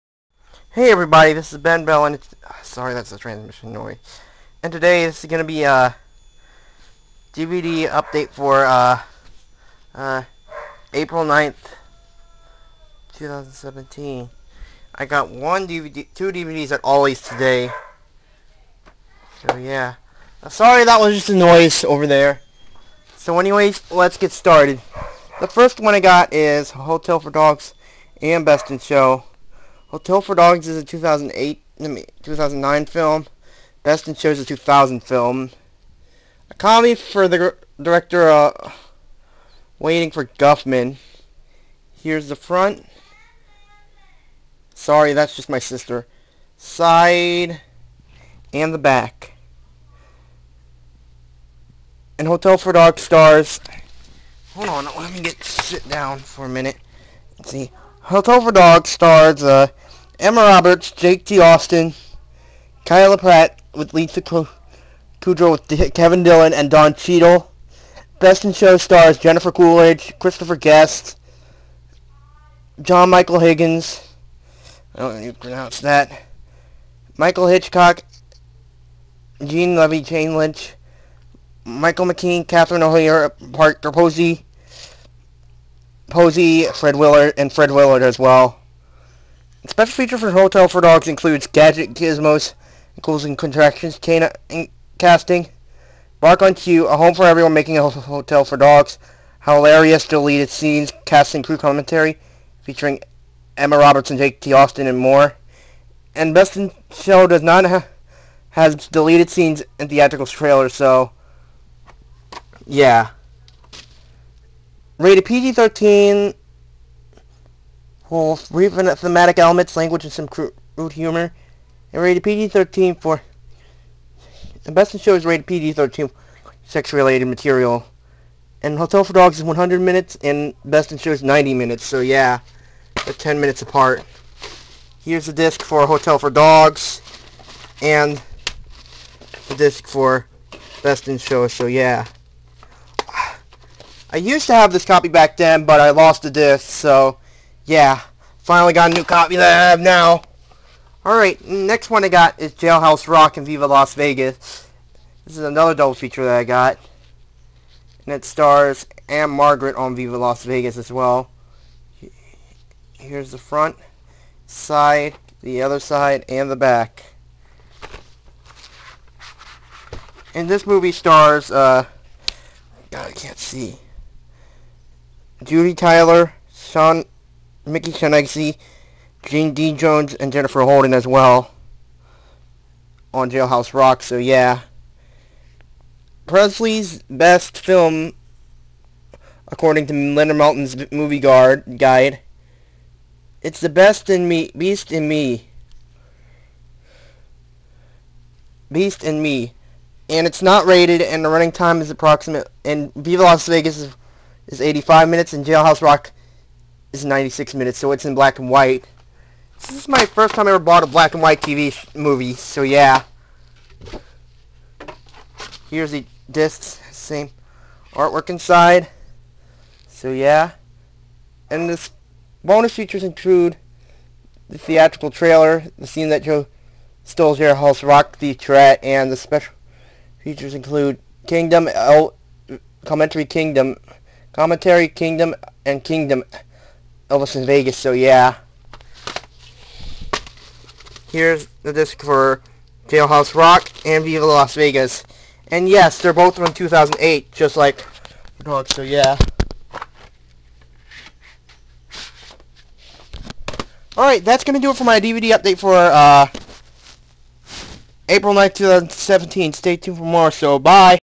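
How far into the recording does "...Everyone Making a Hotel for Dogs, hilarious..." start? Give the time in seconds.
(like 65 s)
97 s.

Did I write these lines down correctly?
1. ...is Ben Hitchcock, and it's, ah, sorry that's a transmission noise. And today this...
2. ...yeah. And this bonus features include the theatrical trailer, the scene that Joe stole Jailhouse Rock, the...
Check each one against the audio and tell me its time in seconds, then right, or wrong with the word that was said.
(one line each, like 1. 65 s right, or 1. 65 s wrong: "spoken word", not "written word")
1. 1 s wrong: "Bell", not "Hitchcock"
2. 220 s right.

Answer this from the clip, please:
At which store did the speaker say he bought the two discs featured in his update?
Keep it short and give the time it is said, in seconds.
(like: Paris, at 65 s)
Ollie's, at 16 s.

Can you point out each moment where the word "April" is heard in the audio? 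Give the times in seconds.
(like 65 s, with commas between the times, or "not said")
10 s, 258 s.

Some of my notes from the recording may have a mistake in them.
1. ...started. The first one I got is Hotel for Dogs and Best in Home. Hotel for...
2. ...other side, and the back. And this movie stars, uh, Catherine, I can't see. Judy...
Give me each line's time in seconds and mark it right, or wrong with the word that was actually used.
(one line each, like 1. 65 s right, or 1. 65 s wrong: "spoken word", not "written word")
1. 24 s wrong: "Show", not "Home"
2. 165 s wrong: "God", not "Catherine".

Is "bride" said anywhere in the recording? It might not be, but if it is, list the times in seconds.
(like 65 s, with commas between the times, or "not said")
not said.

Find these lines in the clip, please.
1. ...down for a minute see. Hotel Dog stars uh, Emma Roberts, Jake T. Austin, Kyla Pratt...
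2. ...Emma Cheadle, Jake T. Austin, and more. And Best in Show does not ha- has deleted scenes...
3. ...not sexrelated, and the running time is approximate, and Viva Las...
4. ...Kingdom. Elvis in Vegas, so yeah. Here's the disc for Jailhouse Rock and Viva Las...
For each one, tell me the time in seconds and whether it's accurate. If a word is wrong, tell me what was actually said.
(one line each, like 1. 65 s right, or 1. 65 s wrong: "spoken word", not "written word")
1. 55 s right
2. 103 s wrong: "Robertson", not "Cheadle"
3. 200 s wrong: "rated", not "sexrelated"
4. 235 s right.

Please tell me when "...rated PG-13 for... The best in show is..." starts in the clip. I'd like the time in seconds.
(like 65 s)
122 s.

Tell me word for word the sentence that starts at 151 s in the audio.
Alright, next one I got is Jailhouse Rock and Viva Las Vegas.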